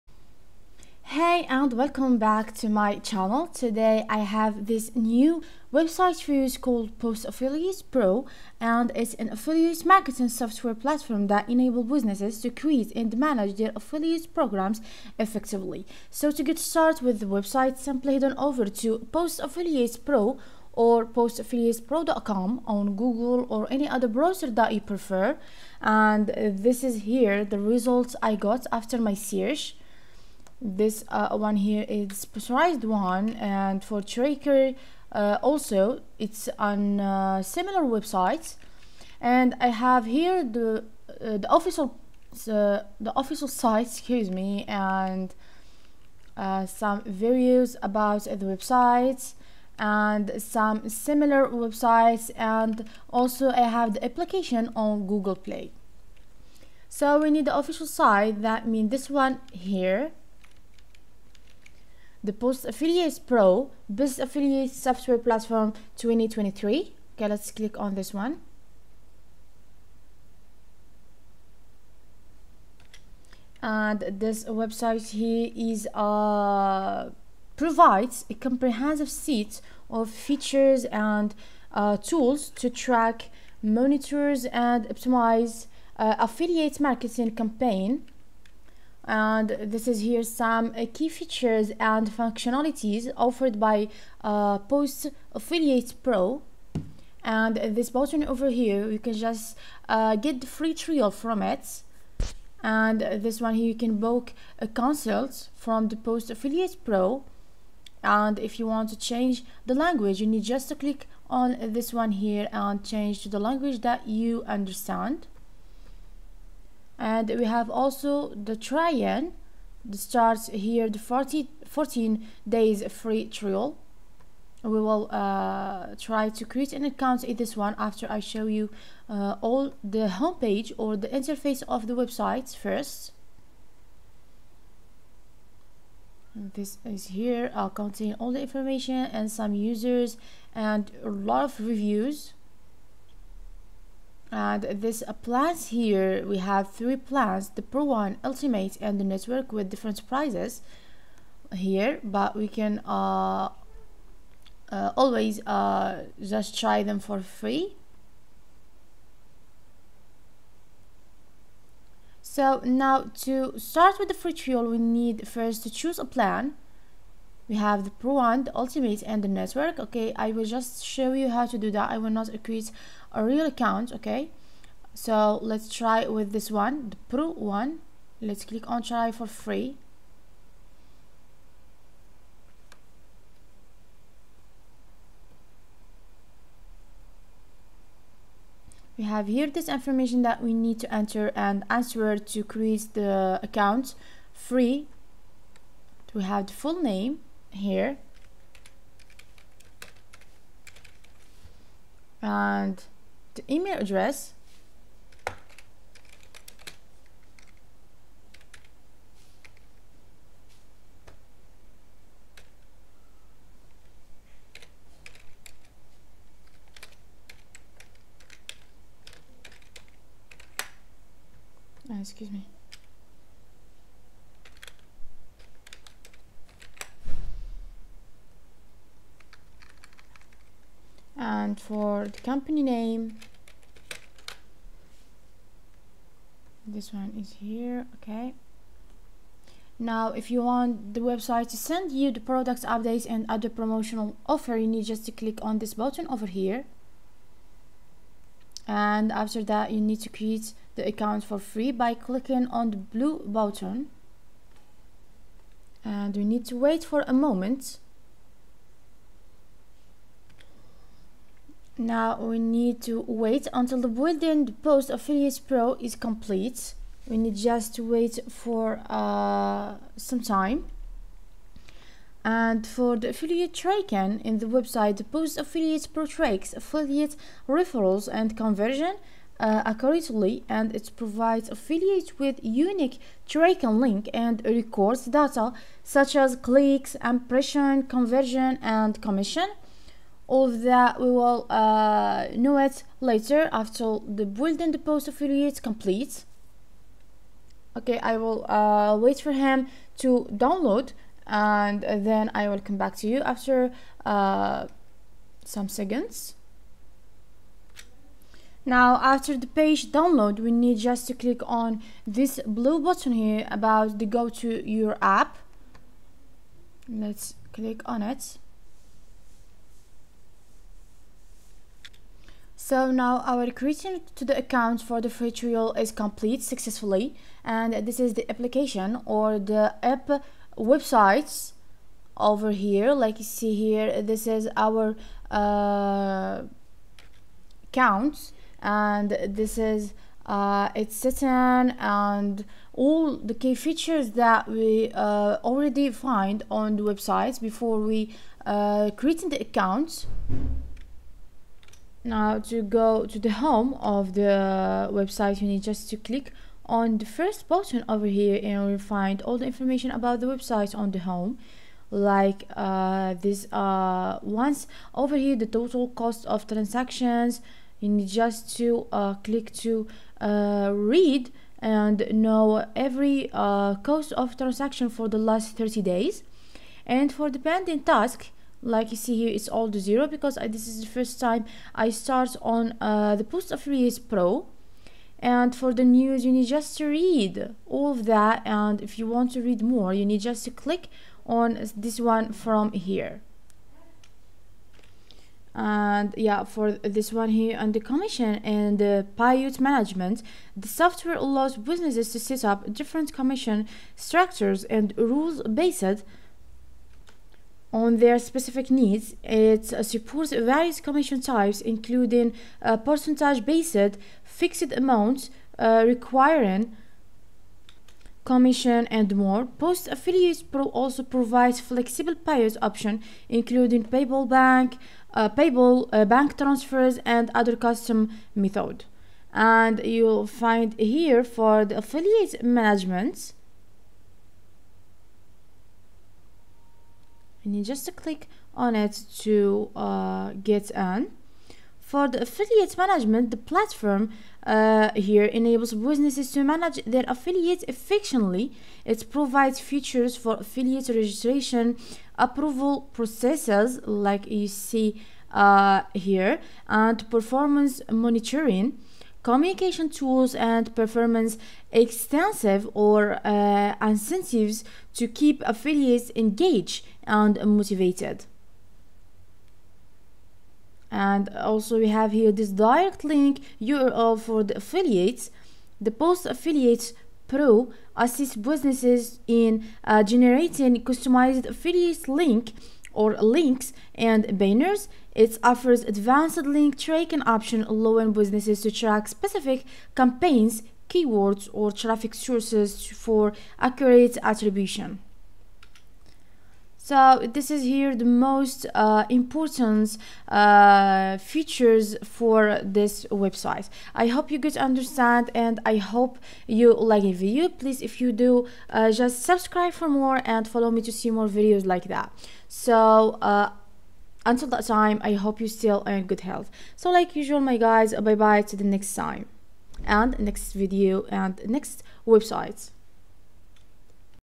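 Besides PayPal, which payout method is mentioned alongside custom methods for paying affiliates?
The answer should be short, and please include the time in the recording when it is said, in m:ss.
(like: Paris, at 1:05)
Bank transfers, at 7:06.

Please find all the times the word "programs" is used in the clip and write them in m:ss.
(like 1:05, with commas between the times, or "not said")
0:14.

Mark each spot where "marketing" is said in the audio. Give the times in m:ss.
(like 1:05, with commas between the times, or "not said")
0:09, 1:26.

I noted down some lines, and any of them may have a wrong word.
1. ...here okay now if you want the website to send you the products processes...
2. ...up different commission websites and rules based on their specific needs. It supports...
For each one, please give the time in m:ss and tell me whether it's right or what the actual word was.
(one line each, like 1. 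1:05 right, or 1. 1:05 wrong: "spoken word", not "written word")
1. 3:57 wrong: "updates", not "processes"
2. 6:42 wrong: "structures", not "websites".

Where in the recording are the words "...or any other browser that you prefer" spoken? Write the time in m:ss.
0:23.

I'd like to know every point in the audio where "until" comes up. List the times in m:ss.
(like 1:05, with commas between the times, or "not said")
4:23, 8:34.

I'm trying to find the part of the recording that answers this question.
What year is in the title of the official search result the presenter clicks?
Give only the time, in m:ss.
1:05.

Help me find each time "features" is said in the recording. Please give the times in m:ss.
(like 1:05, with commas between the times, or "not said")
1:20, 1:31, 5:43, 7:29, 8:21.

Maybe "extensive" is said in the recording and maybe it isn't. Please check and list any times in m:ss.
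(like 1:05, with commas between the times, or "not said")
7:41.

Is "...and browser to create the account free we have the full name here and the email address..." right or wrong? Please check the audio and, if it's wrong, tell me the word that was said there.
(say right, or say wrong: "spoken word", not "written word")
wrong: "answer", not "browser".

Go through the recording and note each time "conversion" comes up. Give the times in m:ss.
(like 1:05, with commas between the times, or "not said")
4:38, 4:47.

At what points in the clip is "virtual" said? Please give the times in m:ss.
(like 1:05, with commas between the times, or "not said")
5:25.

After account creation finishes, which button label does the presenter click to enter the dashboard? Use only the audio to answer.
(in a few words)
Go to your app.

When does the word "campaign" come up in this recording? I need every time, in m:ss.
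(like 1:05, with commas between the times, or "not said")
1:27, 8:09.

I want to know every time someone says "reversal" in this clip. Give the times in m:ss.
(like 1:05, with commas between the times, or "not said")
not said.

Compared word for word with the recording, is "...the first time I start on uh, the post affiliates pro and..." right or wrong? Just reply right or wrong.
right.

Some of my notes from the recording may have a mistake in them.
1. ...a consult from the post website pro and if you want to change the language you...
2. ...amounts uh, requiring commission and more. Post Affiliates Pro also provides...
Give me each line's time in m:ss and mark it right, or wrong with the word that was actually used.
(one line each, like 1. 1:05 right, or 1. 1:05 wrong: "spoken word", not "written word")
1. 1:44 wrong: "affiliate", not "website"
2. 6:54 right.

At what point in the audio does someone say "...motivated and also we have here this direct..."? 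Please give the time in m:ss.
7:47.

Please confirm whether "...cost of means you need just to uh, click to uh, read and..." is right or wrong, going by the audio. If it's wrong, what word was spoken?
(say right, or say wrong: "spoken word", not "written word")
wrong: "transactions", not "means".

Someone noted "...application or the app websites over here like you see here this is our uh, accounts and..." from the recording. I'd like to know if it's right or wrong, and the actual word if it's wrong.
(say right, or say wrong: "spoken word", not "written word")
right.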